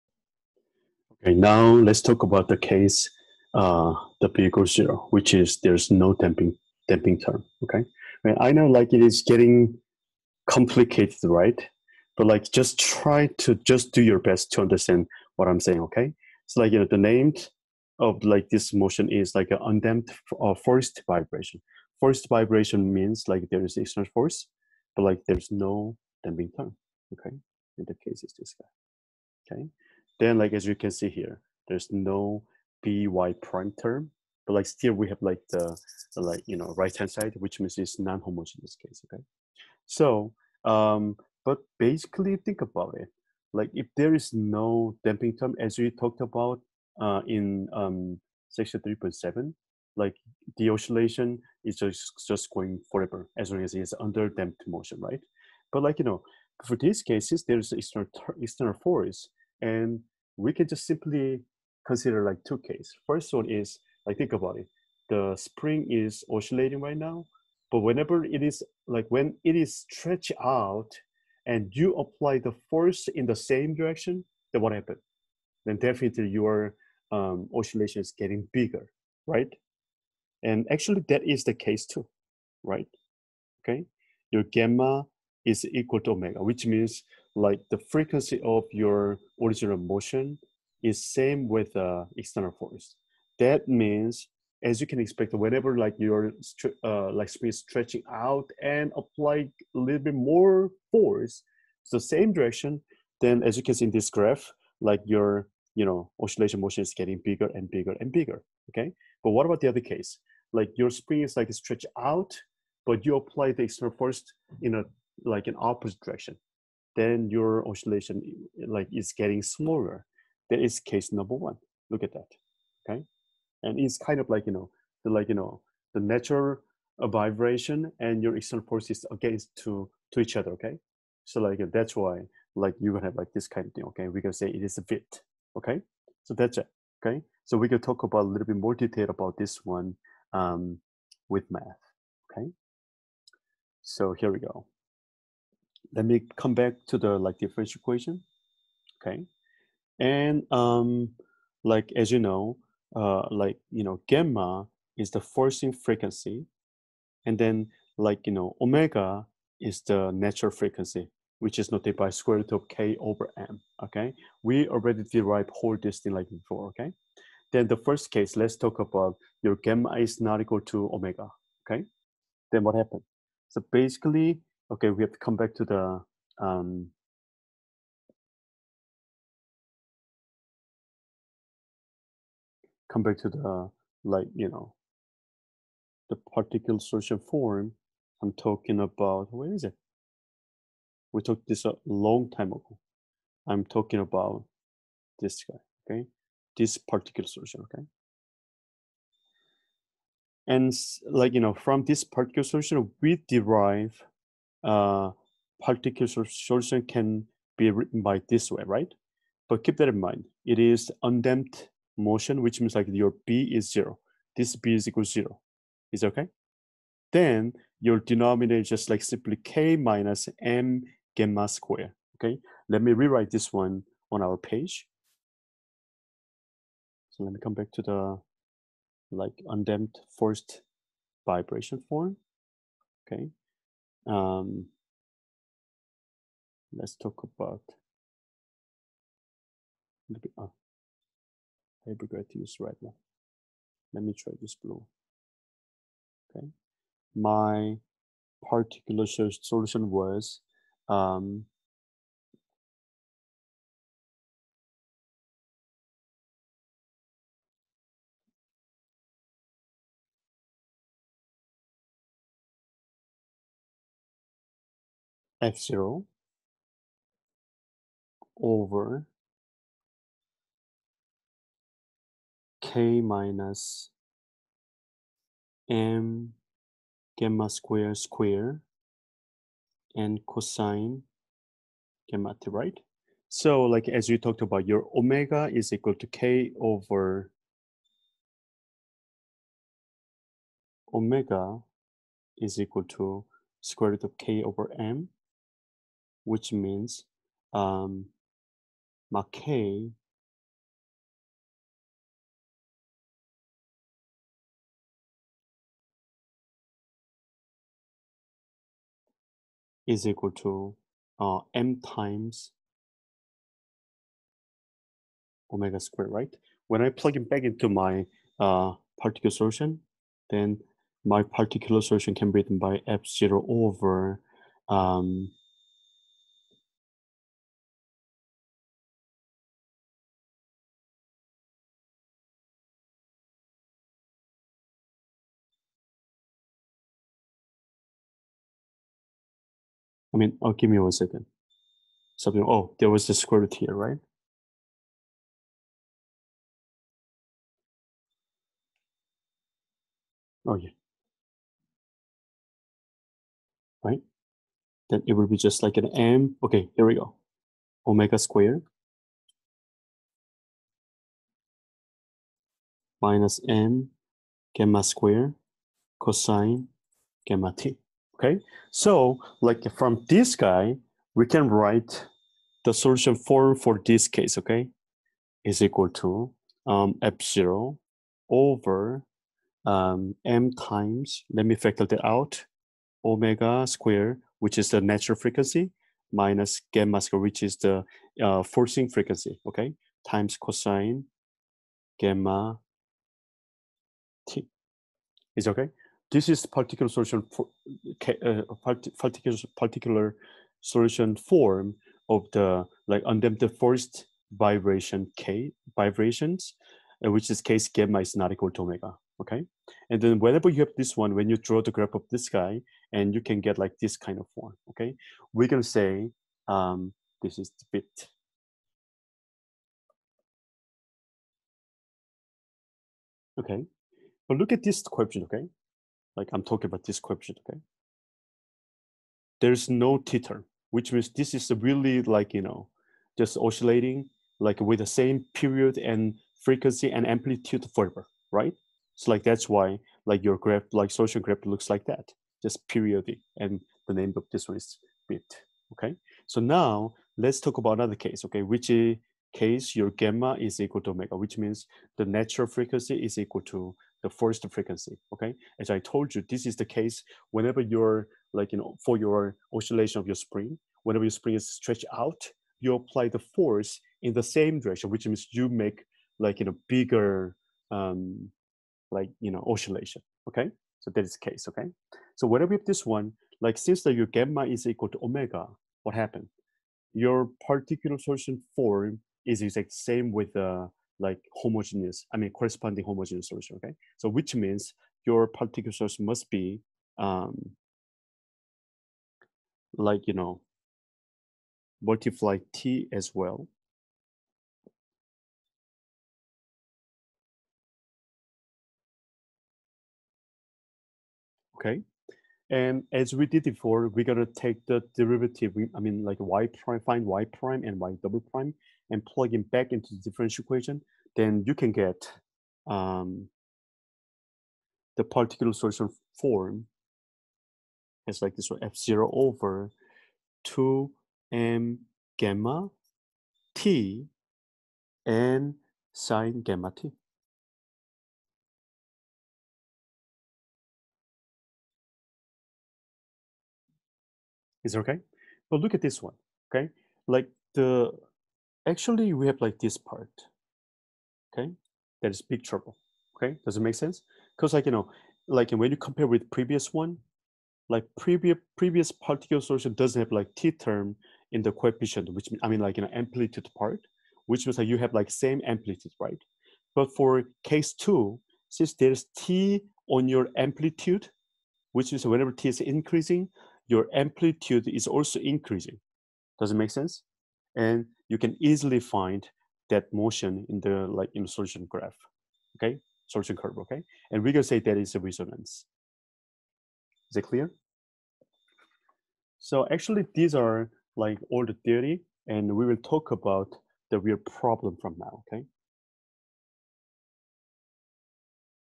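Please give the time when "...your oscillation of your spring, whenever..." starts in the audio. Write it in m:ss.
7:38.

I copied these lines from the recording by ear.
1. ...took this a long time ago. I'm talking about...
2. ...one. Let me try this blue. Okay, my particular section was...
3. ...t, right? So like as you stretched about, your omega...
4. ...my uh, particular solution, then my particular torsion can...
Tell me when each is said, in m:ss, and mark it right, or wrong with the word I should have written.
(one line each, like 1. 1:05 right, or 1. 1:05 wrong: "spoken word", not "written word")
1. 3:11 right
2. 4:02 wrong: "solution", not "section"
3. 4:42 wrong: "talked", not "stretched"
4. 5:17 wrong: "solution", not "torsion".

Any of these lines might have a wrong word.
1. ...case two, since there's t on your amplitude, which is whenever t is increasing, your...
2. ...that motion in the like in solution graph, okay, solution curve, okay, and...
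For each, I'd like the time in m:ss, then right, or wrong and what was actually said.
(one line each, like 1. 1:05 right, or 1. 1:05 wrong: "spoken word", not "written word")
1. 9:17 right
2. 9:29 right.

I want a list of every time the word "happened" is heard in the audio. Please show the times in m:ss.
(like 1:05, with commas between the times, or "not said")
1:14, 2:52, 7:55.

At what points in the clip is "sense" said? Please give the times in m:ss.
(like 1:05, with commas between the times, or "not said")
9:03, 9:26.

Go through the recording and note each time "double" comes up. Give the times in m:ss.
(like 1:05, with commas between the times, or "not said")
8:28.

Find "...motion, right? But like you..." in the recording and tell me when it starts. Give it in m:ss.
0:54.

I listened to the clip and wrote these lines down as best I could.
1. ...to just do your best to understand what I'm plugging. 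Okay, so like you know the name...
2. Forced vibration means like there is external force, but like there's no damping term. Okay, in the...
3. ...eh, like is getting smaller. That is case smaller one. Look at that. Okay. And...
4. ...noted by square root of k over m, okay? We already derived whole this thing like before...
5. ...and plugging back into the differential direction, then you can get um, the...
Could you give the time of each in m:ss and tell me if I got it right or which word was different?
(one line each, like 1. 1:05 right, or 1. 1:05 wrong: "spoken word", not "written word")
1. 0:13 wrong: "saying", not "plugging"
2. 0:21 right
3. 1:58 wrong: "number", not "smaller"
4. 2:41 right
5. 8:28 wrong: "equation", not "direction".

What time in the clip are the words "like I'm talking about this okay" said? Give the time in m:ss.
7:06.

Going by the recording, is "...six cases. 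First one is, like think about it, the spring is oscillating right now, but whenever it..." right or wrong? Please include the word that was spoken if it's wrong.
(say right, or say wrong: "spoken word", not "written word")
wrong: "two", not "six".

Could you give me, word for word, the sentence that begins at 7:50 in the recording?
So that is the case, okay?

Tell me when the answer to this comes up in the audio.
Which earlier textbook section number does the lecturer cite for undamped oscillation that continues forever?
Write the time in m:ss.
0:48.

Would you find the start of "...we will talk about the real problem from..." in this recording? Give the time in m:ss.
9:42.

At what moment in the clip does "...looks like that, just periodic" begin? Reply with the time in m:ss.
7:21.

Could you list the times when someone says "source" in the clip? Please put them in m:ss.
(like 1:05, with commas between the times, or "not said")
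8:05.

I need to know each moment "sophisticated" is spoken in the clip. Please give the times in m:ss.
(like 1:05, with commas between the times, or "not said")
not said.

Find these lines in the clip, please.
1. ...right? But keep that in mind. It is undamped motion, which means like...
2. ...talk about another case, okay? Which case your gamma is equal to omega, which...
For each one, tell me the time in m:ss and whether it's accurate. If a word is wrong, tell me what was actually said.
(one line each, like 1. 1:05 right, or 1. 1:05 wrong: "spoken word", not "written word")
1. 3:28 right
2. 7:27 right.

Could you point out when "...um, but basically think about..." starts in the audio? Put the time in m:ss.
0:40.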